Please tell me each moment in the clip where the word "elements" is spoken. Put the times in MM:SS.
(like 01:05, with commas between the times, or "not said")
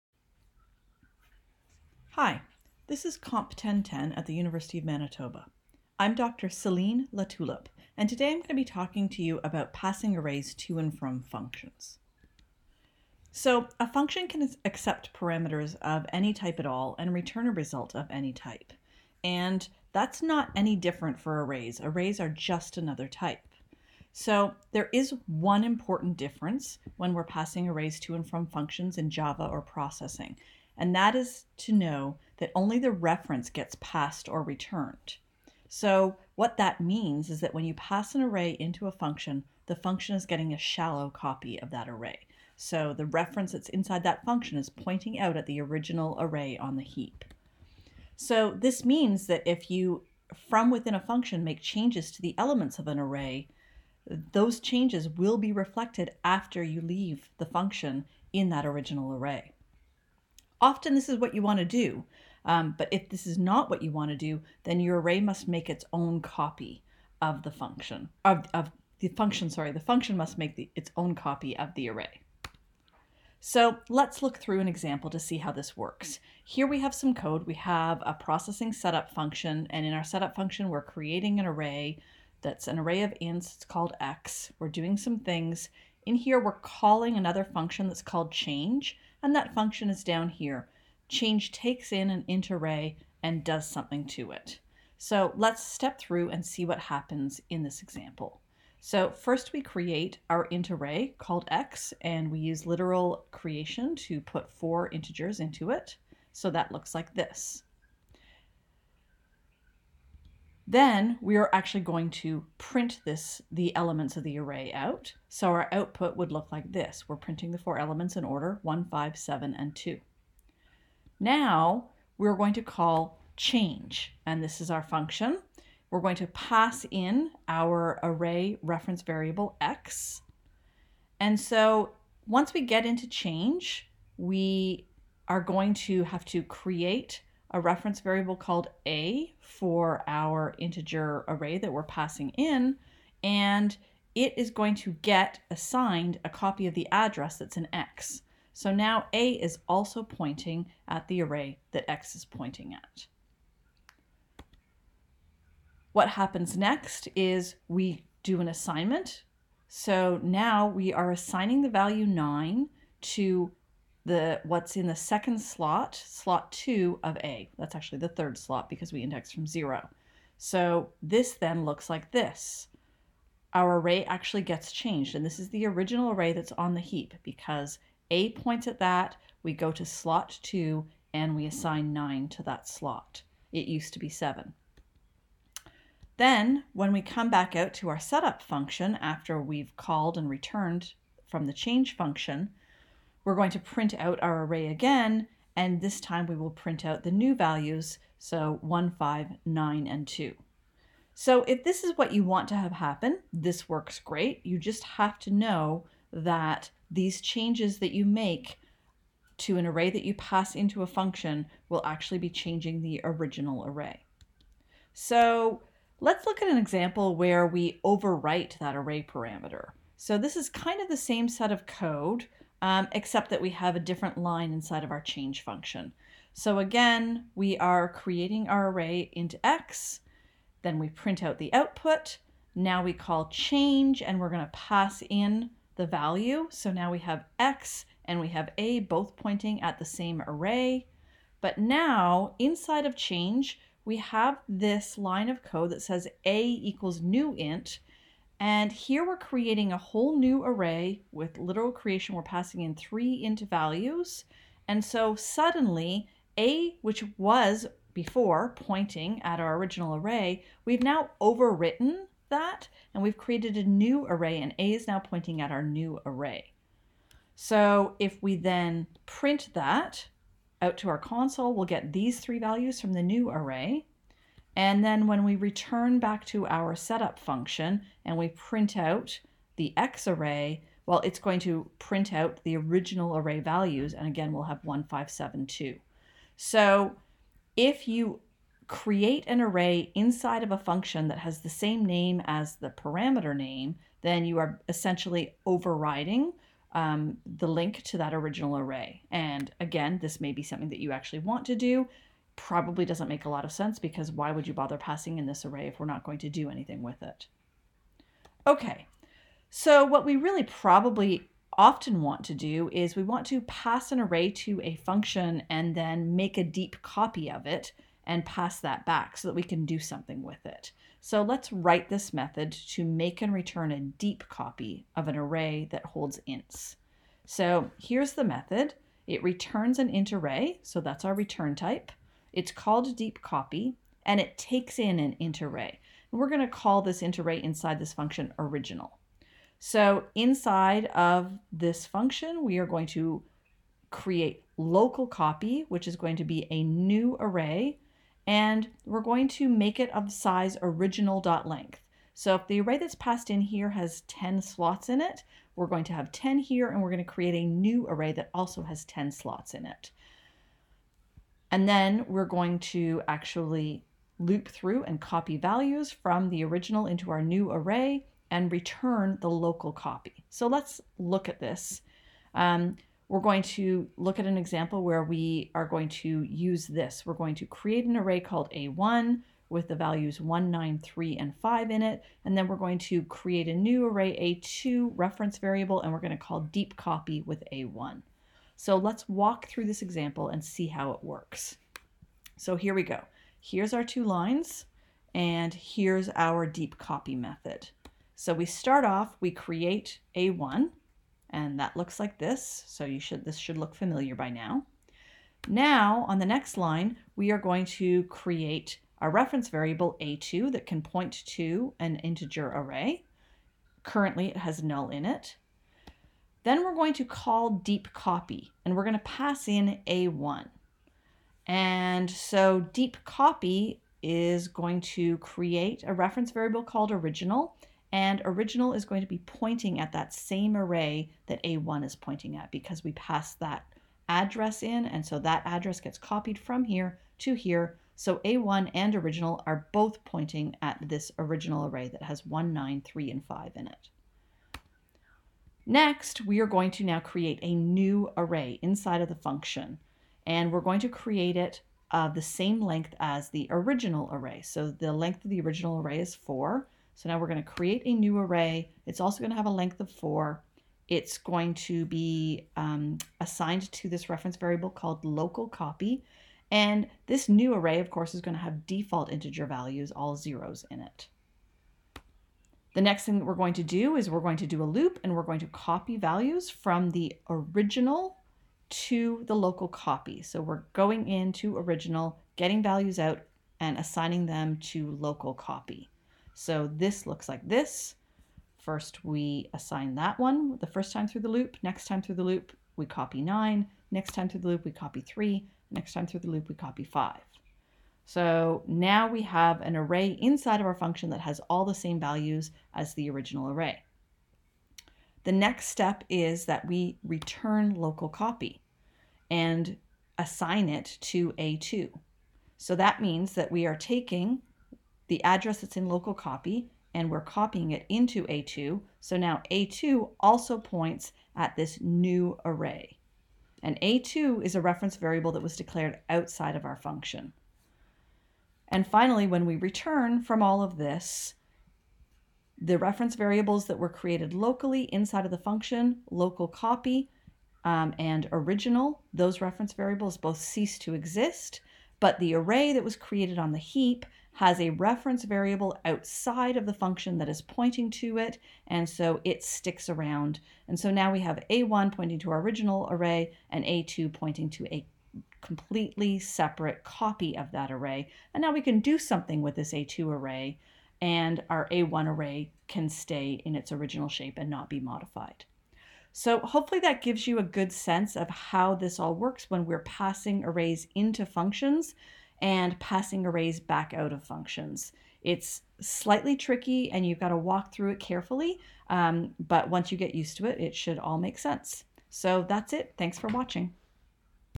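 00:52, 01:53, 01:57.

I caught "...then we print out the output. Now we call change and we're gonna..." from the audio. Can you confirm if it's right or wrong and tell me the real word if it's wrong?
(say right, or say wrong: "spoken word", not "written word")
right.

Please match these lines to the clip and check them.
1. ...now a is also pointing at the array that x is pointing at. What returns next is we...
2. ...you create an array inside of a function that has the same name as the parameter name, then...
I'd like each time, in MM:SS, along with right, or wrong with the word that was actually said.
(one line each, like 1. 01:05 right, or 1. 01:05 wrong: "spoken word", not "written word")
1. 02:28 wrong: "happens", not "returns"
2. 04:47 right.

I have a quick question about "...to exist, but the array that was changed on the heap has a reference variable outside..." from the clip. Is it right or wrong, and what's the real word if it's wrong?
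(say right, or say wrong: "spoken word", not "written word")
wrong: "created", not "changed".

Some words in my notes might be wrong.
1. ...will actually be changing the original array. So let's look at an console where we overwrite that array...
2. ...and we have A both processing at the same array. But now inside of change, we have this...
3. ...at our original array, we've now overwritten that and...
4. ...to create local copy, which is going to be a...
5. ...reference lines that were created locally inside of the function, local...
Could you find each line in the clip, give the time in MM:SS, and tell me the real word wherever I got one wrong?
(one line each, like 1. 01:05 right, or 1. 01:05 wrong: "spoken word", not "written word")
1. 03:31 wrong: "example", not "console"
2. 03:58 wrong: "pointing", not "processing"
3. 04:19 right
4. 05:42 right
5. 08:52 wrong: "variables", not "lines".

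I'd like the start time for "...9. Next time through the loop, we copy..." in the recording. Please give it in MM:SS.
08:13.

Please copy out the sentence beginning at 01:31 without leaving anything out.
Change takes in an int array and does something to it.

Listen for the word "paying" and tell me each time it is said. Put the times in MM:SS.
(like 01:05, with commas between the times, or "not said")
not said.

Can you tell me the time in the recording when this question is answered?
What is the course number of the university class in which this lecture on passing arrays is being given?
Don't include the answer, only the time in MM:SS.
00:03.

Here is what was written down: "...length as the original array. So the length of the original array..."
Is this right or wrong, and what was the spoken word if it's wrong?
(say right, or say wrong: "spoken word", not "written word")
right.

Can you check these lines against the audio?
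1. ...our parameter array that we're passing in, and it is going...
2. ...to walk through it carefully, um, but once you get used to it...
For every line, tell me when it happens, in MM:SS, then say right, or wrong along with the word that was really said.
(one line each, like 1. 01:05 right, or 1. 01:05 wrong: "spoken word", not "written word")
1. 02:20 wrong: "integer", not "parameter"
2. 09:37 right.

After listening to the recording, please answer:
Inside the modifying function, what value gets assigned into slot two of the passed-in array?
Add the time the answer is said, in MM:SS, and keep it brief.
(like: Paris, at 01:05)
9, at 02:41.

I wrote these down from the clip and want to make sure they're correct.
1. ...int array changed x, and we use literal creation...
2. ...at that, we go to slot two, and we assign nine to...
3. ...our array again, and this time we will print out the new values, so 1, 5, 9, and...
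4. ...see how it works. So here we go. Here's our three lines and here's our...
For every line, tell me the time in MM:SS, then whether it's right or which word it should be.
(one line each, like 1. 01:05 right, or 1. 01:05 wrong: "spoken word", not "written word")
1. 01:40 wrong: "called", not "changed"
2. 02:58 right
3. 03:14 right
4. 06:30 wrong: "two", not "three".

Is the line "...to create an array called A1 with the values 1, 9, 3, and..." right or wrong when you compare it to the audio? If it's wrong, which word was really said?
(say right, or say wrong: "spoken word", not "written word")
right.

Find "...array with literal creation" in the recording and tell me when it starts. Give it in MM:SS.
04:10.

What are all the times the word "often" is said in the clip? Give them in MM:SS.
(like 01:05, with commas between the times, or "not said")
01:00, 05:11.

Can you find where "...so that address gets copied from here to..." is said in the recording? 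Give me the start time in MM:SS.
07:15.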